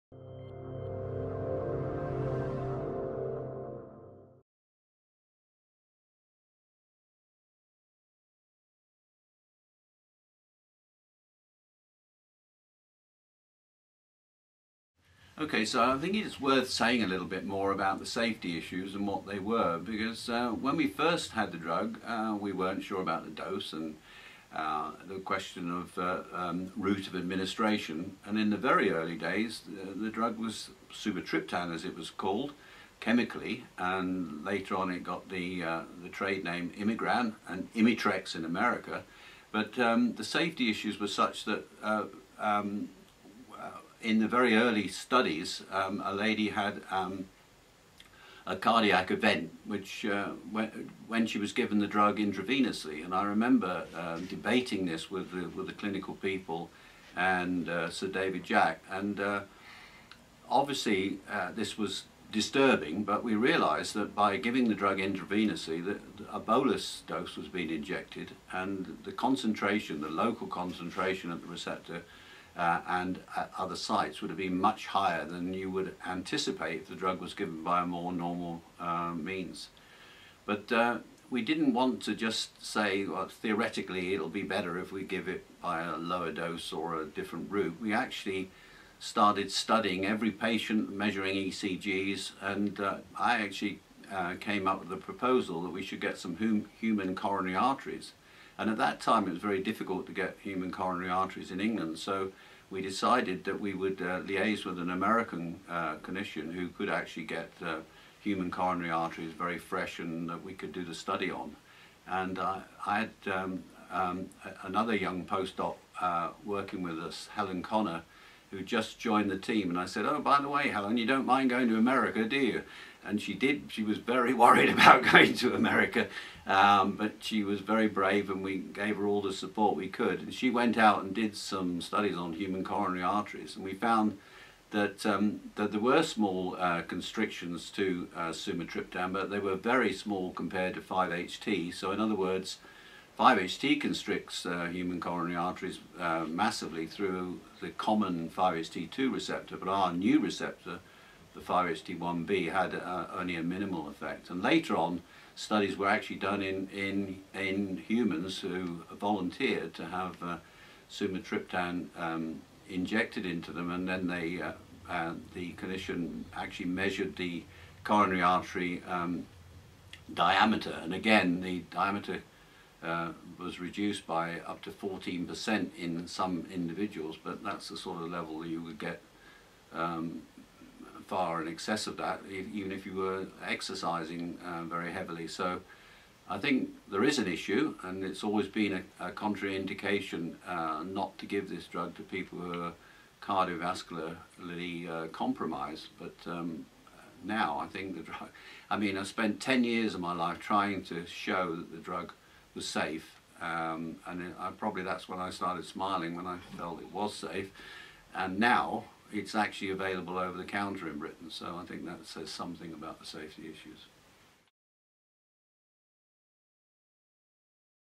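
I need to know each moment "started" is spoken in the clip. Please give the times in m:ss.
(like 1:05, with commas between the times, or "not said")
1:28, 3:25.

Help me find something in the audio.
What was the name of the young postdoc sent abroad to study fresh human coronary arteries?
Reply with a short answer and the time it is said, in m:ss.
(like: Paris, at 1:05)
Helen Connor, at 1:57.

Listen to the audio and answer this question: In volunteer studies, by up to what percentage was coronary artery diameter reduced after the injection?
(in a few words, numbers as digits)
14%.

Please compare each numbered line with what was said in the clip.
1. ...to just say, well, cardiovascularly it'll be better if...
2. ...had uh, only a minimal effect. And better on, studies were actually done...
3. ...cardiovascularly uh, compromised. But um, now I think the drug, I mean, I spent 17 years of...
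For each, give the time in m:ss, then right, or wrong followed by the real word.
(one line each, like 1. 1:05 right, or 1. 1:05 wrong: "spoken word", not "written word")
1. 1:22 wrong: "theoretically", not "cardiovascularly"
2. 2:32 wrong: "later", not "better"
3. 3:13 wrong: "10", not "17".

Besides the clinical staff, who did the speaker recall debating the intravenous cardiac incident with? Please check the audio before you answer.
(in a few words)
Sir David Jack.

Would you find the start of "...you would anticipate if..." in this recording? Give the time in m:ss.
1:15.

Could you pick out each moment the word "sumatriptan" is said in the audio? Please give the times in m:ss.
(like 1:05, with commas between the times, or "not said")
0:30, 2:18, 2:40.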